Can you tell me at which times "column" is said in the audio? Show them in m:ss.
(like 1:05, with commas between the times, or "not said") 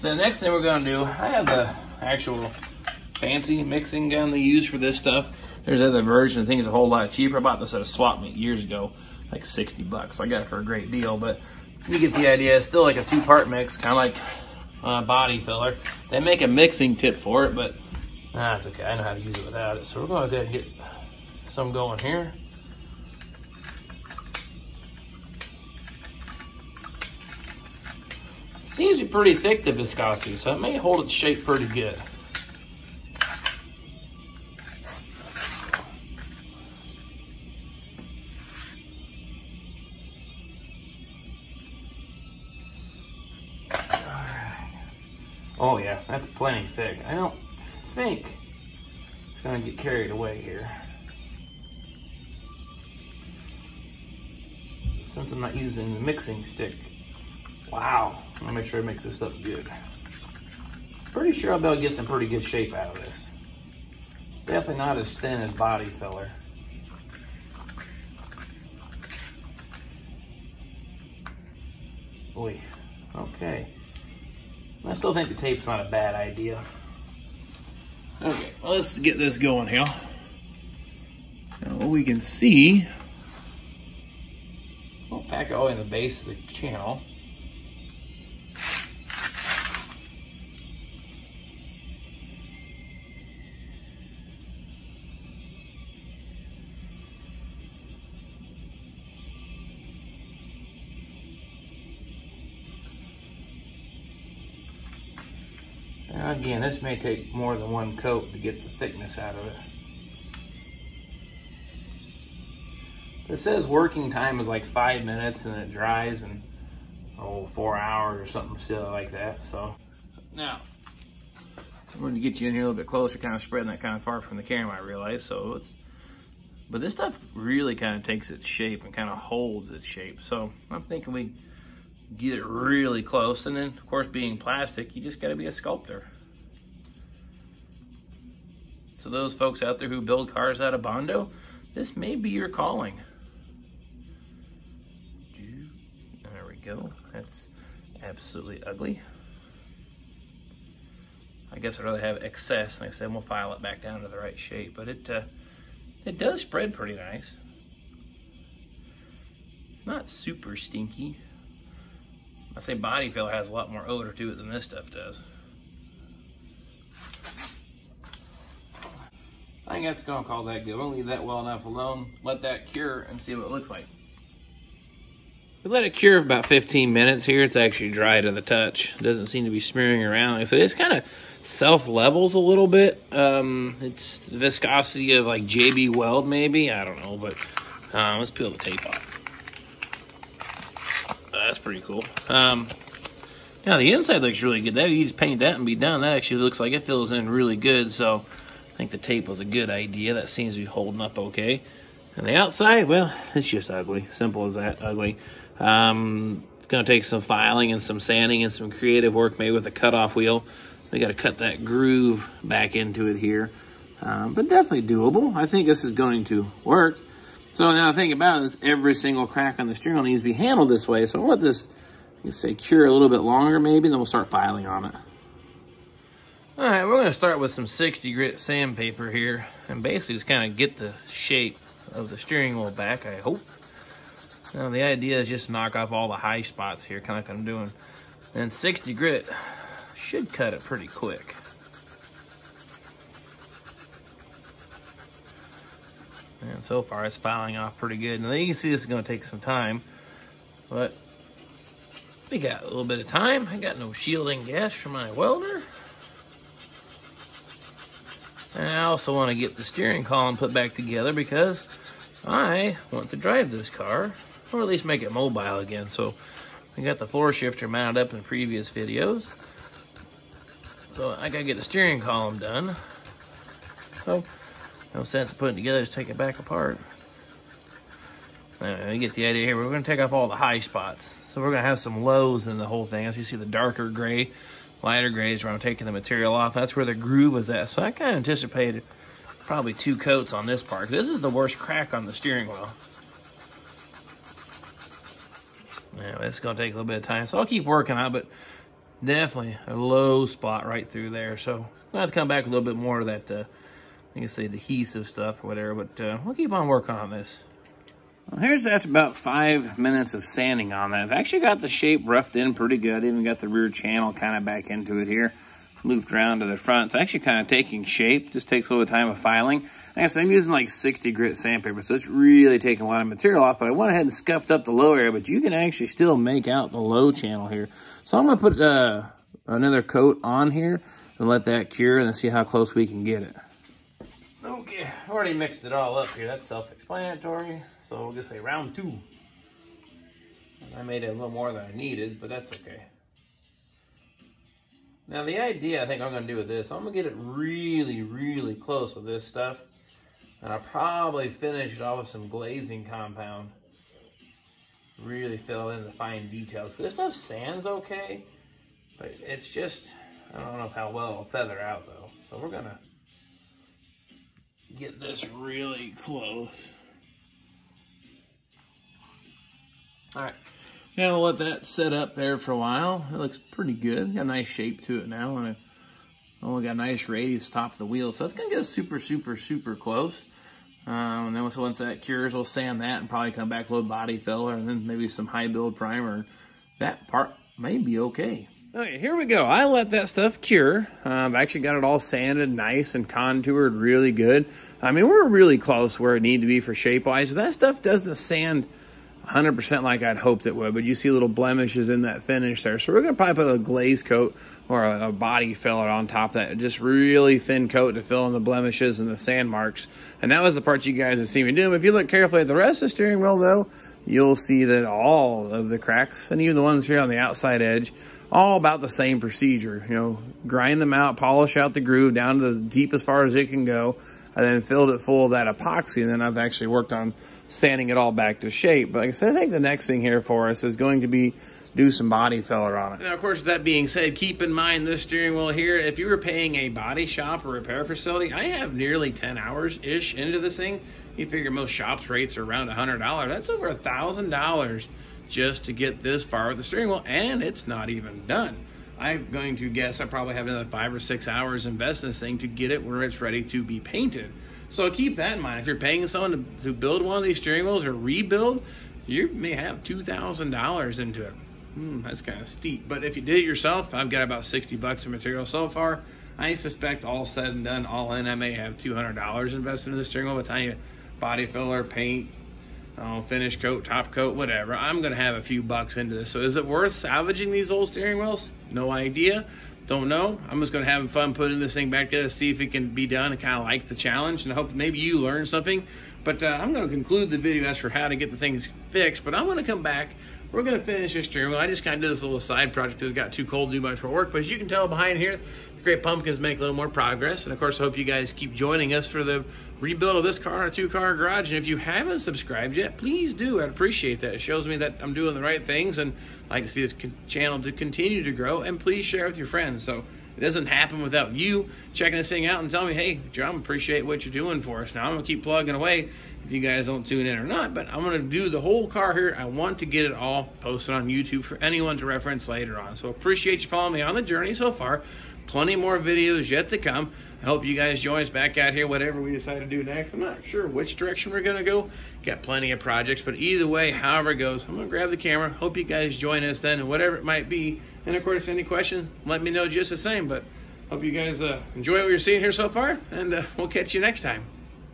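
4:20, 4:32.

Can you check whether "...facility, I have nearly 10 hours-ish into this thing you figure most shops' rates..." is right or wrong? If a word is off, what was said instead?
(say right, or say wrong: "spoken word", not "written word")
right.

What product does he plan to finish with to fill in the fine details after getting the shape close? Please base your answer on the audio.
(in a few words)
glazing compound.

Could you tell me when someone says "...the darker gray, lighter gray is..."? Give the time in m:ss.
4:43.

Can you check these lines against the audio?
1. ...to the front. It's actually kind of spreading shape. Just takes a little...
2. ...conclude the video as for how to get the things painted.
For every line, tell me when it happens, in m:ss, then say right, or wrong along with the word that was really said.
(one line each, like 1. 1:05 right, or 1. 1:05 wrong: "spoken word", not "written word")
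1. 5:16 wrong: "taking", not "spreading"
2. 8:06 wrong: "fixed", not "painted".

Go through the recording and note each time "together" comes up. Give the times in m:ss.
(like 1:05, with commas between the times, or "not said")
4:20, 4:35, 8:02.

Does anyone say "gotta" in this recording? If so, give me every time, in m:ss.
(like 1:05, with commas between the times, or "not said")
3:30, 4:31.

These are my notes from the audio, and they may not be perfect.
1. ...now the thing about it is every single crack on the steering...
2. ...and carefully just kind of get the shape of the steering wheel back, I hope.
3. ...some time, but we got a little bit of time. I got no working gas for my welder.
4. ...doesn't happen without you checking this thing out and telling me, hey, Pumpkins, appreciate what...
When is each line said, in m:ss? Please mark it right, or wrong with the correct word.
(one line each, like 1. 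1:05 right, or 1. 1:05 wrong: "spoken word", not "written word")
1. 3:37 right
2. 3:49 wrong: "basically", not "carefully"
3. 4:09 wrong: "shielding", not "working"
4. 8:30 wrong: "Jon", not "Pumpkins".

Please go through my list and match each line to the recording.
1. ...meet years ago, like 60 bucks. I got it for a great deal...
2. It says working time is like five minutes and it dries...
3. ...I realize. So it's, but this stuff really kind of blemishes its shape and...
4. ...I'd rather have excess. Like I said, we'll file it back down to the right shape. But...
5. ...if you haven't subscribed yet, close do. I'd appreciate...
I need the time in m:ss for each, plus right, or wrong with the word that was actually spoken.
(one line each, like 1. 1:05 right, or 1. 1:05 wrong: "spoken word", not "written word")
1. 0:08 right
2. 1:53 right
3. 2:04 wrong: "takes", not "blemishes"
4. 2:31 right
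5. 8:21 wrong: "please", not "close".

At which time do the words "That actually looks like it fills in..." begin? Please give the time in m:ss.
3:15.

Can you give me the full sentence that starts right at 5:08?
Well, here's after about five minutes of sanding on that.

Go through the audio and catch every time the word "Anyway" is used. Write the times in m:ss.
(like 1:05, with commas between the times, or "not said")
4:38, 4:55.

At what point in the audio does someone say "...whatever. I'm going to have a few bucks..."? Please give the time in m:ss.
7:54.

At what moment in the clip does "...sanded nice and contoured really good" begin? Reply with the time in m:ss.
6:31.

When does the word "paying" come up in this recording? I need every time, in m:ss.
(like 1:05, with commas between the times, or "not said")
7:16, 7:35.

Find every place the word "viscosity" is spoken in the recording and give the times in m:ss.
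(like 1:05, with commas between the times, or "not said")
0:29, 3:04.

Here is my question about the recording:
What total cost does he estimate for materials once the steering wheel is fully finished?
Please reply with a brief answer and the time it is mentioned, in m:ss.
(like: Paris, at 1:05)
$200, at 7:48.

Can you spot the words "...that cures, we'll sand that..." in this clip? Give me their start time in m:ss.
6:21.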